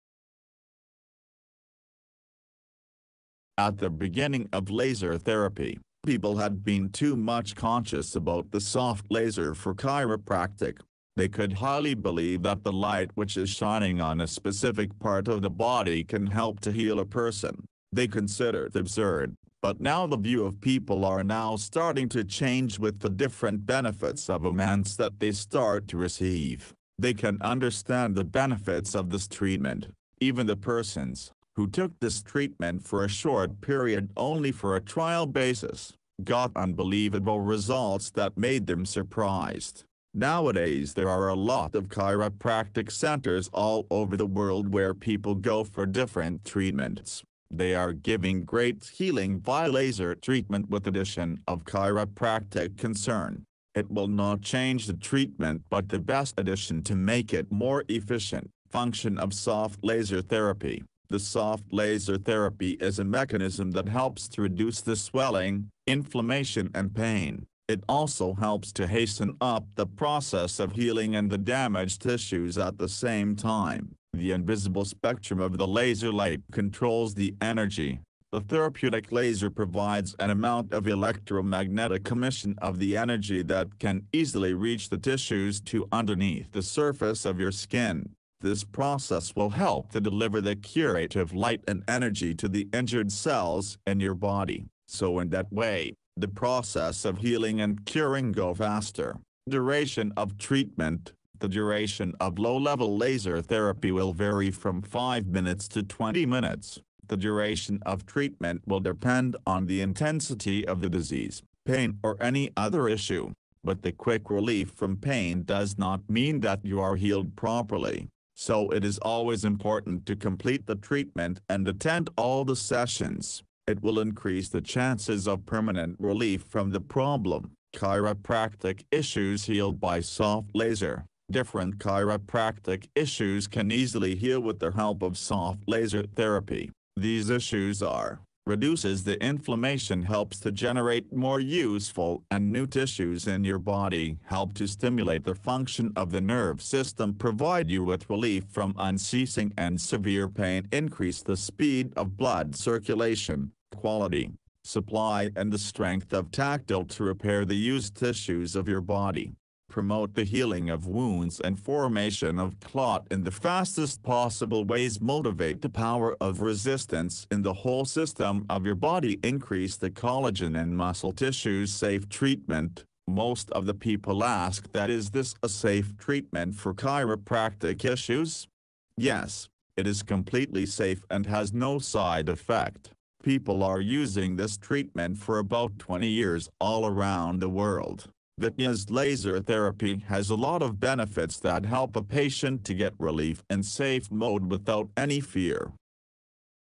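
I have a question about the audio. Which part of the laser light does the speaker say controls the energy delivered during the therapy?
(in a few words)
invisible spectrum.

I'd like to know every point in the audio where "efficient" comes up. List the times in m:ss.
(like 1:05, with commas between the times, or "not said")
0:57.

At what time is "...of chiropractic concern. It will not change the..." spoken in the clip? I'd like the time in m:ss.
0:51.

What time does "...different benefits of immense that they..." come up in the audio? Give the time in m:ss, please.
0:23.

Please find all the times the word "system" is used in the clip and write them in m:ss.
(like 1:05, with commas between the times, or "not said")
2:26, 2:47.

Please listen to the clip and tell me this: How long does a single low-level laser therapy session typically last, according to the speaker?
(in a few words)
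5 to 20 minutes.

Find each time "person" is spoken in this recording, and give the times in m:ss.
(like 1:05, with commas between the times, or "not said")
0:17, 0:30.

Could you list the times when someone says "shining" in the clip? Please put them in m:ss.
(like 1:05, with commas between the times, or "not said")
0:13.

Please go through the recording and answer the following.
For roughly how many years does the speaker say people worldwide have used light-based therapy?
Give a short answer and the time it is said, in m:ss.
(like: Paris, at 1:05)
20 years, at 3:05.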